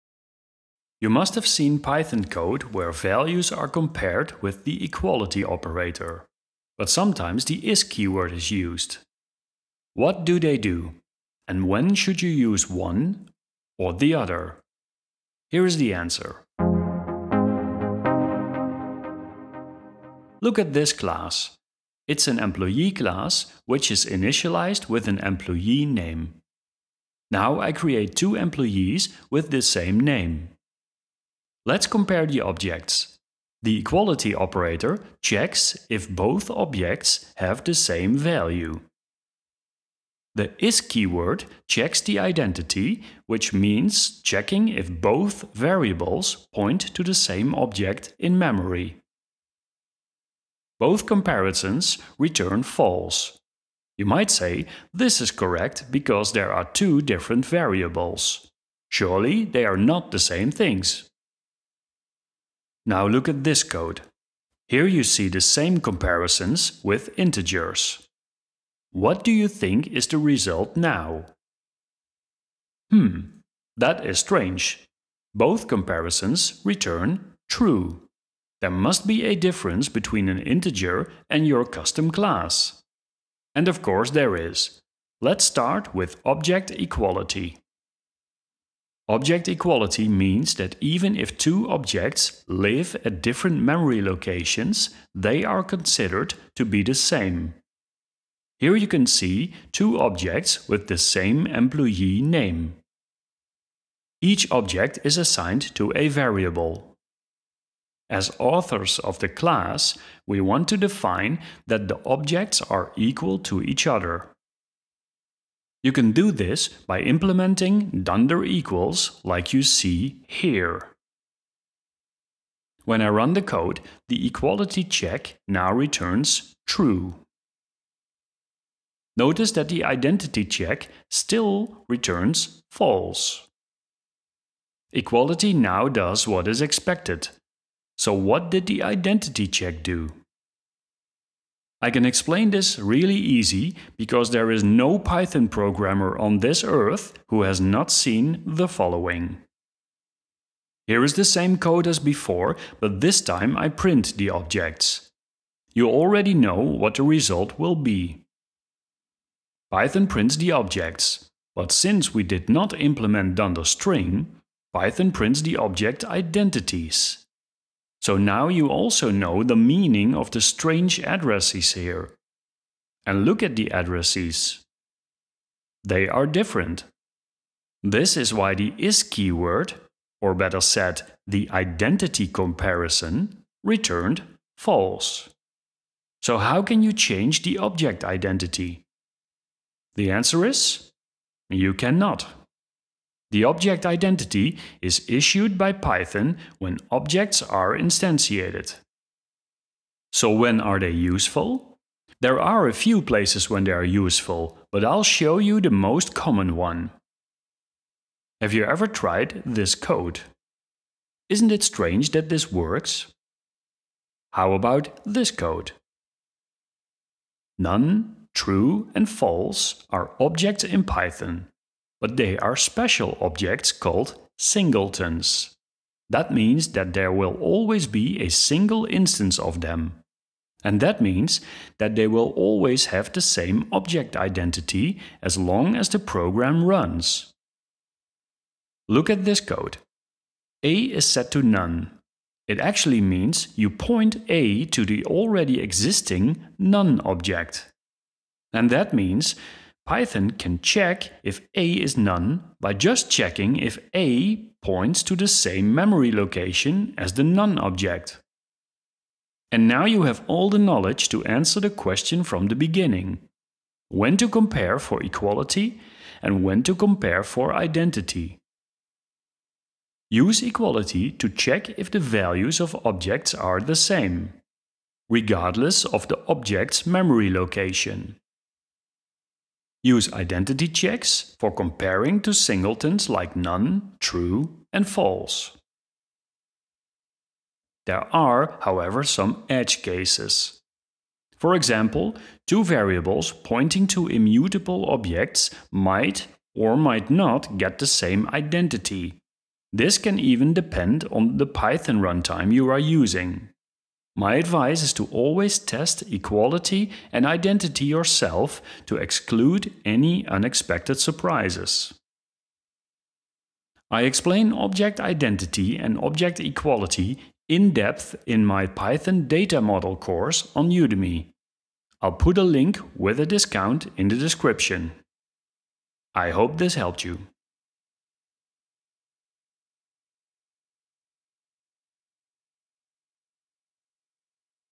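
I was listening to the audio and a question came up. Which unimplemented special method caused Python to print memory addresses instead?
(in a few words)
dunder string.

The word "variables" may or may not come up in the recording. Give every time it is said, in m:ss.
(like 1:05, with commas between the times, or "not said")
0:45, 0:57, 1:46, 4:52.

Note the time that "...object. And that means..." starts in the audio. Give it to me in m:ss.
4:07.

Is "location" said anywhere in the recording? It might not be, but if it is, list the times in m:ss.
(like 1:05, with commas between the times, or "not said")
1:34, 4:16, 4:37.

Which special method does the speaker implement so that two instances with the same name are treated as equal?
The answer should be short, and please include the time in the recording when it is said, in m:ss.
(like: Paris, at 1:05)
dunder equals, at 1:58.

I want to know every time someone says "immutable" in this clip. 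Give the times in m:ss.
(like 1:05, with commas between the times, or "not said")
4:54.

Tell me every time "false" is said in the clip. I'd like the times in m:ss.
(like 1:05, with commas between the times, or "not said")
0:52, 2:12, 3:04, 3:39, 4:44.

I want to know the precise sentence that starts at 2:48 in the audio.
So now you also know the meaning of the strange addresses here.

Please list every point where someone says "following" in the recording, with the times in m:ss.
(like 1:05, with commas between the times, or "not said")
2:28.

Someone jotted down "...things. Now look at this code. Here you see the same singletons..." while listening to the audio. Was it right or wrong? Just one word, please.
wrong.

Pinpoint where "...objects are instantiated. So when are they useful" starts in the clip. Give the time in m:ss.
3:16.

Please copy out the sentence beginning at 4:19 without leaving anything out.
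And now you have all the knowledge to answer the question from the beginning.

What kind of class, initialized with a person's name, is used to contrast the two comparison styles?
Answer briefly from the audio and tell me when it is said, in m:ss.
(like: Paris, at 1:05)
Employee class, at 0:22.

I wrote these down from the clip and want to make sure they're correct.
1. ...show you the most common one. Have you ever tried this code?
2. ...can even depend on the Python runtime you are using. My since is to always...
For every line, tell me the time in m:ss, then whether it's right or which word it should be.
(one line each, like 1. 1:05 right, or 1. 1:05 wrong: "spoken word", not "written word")
1. 3:25 right
2. 4:59 wrong: "advice", not "since".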